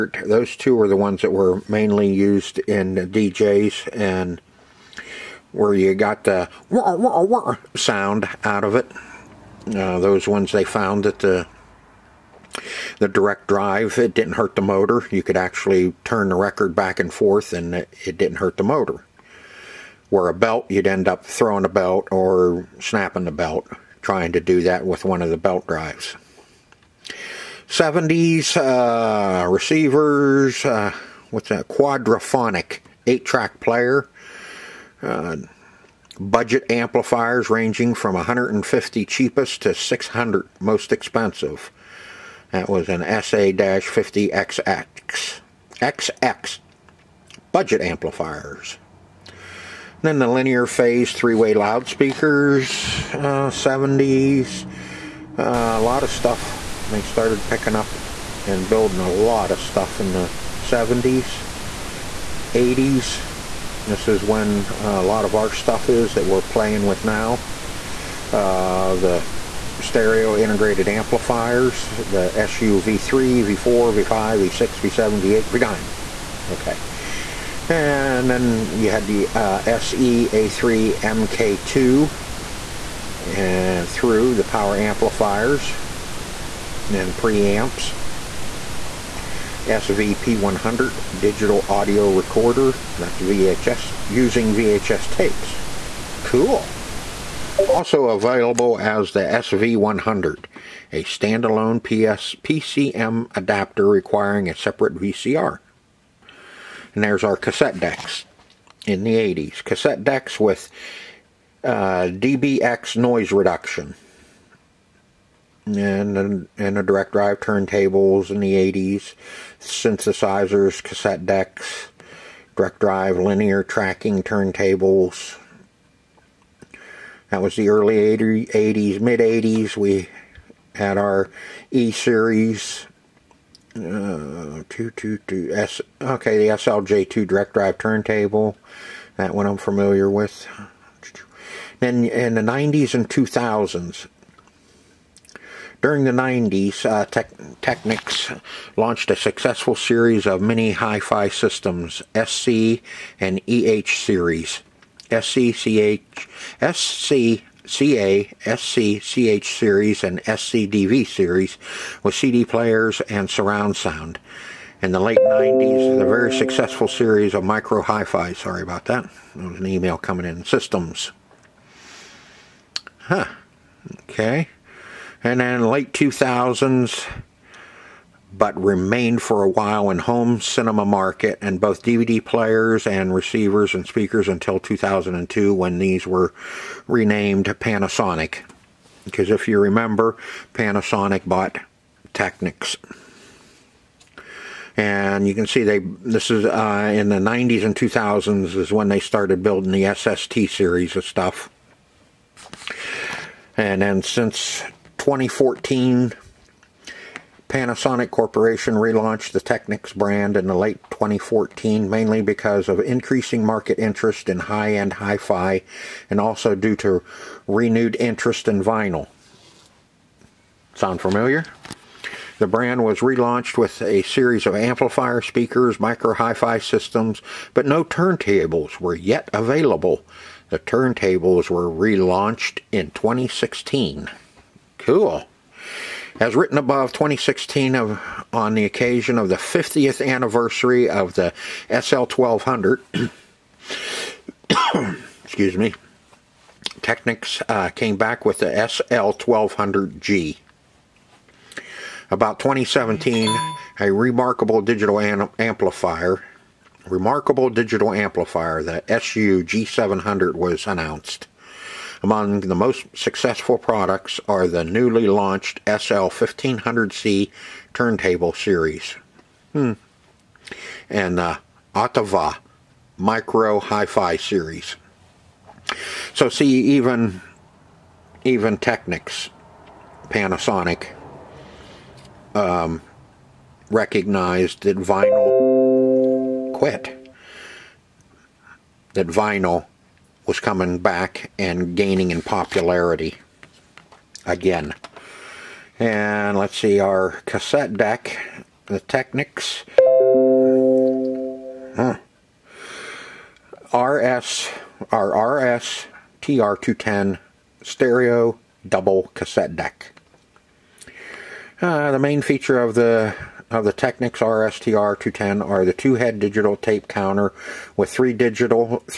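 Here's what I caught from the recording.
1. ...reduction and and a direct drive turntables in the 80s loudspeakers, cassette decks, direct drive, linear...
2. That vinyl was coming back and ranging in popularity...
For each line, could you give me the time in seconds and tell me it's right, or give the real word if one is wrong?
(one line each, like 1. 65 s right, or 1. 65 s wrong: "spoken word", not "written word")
1. 113 s wrong: "synthesizers", not "loudspeakers"
2. 288 s wrong: "gaining", not "ranging".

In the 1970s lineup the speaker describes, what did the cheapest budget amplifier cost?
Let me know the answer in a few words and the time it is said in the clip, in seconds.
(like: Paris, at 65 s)
150, at 38 s.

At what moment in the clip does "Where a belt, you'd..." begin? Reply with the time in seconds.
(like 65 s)
20 s.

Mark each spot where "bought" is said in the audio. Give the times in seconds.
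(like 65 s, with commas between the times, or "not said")
191 s.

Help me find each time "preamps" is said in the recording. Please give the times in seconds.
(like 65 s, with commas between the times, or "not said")
87 s.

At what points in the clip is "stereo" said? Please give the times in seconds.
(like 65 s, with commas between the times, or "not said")
69 s, 307 s.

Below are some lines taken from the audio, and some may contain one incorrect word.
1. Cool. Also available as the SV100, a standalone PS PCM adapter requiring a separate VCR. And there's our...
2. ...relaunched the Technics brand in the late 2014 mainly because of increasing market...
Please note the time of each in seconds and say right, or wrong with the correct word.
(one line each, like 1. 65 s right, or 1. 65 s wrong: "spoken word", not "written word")
1. 96 s right
2. 208 s right.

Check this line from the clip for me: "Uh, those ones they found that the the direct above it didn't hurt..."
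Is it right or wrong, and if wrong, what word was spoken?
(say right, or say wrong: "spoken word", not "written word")
wrong: "drive", not "above".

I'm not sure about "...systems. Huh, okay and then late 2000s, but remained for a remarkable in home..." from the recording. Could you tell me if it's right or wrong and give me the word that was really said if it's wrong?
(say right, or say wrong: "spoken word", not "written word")
wrong: "while", not "remarkable".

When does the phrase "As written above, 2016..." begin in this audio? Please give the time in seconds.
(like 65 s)
236 s.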